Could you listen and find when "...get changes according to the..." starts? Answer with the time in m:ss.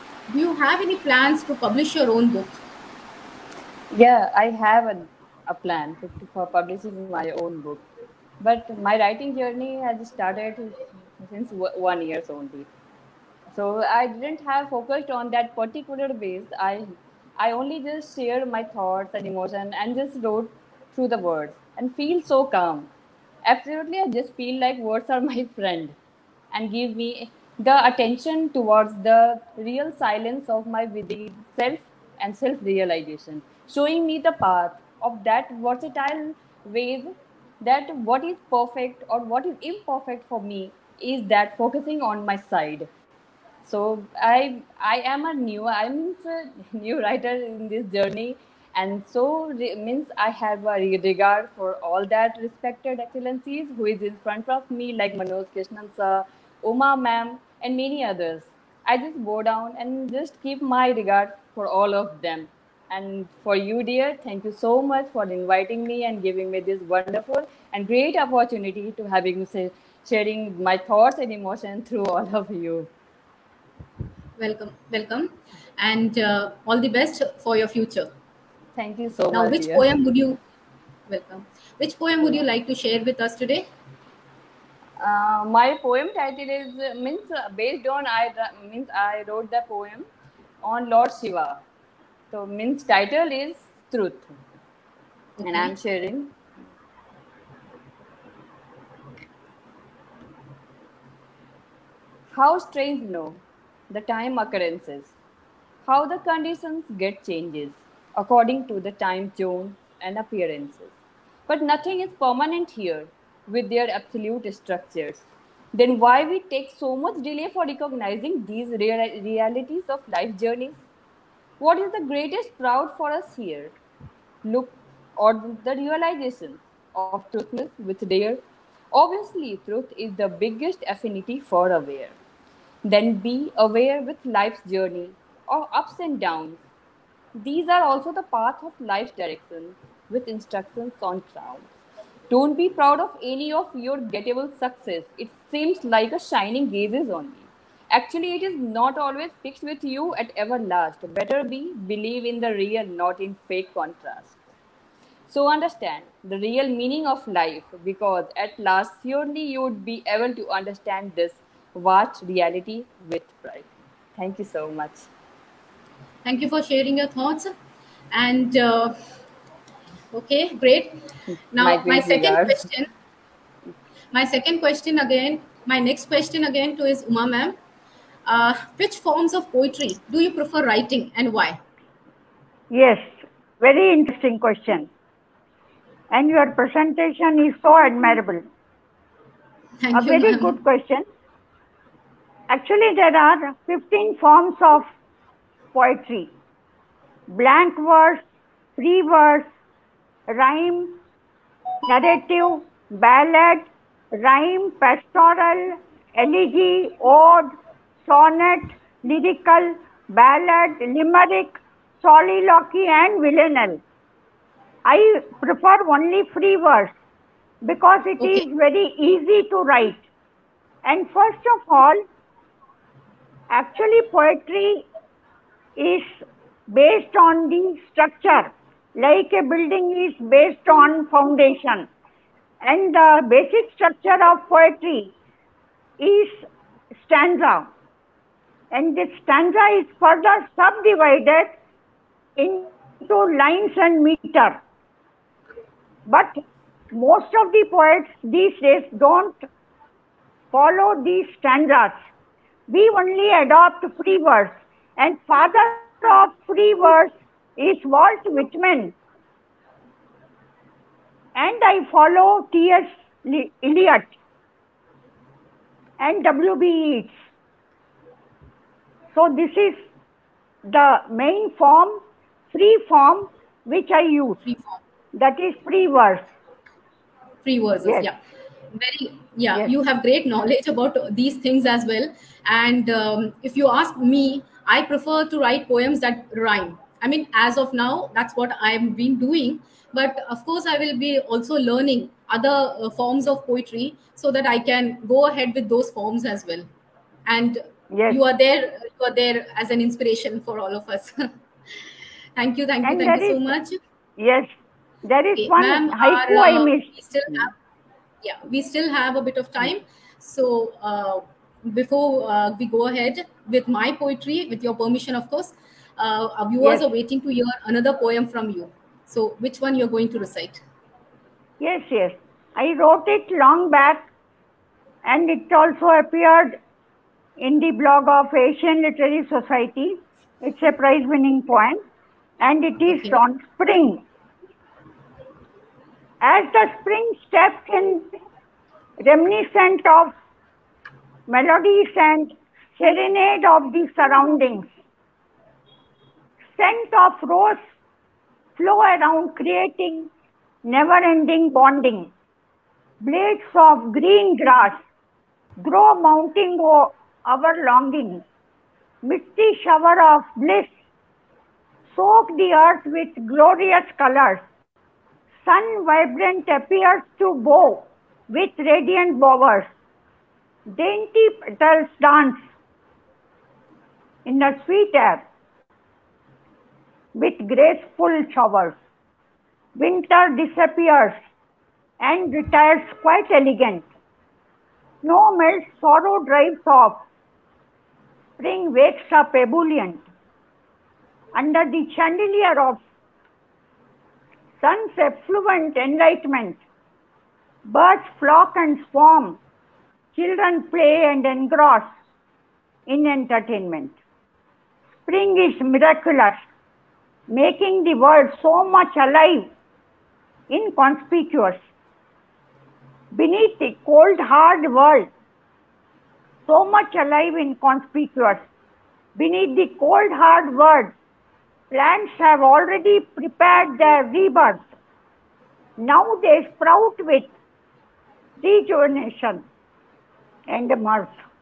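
1:46.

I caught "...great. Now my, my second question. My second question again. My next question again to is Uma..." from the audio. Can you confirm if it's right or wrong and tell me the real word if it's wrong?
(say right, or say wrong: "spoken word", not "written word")
right.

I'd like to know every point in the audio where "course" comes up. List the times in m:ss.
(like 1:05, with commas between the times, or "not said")
4:50, 5:15.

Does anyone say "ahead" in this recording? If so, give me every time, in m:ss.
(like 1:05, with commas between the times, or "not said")
4:55, 5:12.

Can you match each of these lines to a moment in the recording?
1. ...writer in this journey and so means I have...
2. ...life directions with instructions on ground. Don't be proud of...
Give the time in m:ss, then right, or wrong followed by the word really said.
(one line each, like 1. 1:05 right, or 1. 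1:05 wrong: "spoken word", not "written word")
1. 0:47 right
2. 2:18 right.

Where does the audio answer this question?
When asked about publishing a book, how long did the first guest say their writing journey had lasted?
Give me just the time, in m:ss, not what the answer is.
0:11.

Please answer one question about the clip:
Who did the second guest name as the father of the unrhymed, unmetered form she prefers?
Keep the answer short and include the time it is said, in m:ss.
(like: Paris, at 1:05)
Walt Whitman, at 4:17.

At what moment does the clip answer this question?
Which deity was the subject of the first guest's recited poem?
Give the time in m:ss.
1:30.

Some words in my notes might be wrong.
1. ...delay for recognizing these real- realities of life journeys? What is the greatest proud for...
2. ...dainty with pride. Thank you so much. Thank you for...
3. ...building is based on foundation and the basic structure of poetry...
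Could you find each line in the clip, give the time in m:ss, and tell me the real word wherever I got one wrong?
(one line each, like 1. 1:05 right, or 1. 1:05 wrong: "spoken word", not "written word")
1. 1:57 right
2. 2:42 wrong: "reality", not "dainty"
3. 3:49 right.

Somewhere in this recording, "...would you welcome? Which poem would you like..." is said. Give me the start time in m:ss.
1:20.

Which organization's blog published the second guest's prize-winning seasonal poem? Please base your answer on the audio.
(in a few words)
Asian Literary Society.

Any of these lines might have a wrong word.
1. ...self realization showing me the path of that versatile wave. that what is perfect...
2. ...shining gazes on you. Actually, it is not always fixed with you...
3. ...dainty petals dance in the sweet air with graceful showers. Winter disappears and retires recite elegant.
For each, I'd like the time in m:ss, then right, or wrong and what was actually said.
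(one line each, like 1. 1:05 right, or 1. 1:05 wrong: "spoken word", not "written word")
1. 0:32 right
2. 2:26 right
3. 6:10 wrong: "quite", not "recite".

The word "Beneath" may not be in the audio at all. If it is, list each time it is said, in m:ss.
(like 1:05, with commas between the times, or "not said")
6:53, 6:59.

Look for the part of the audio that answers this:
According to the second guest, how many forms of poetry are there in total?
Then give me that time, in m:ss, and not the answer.
3:13.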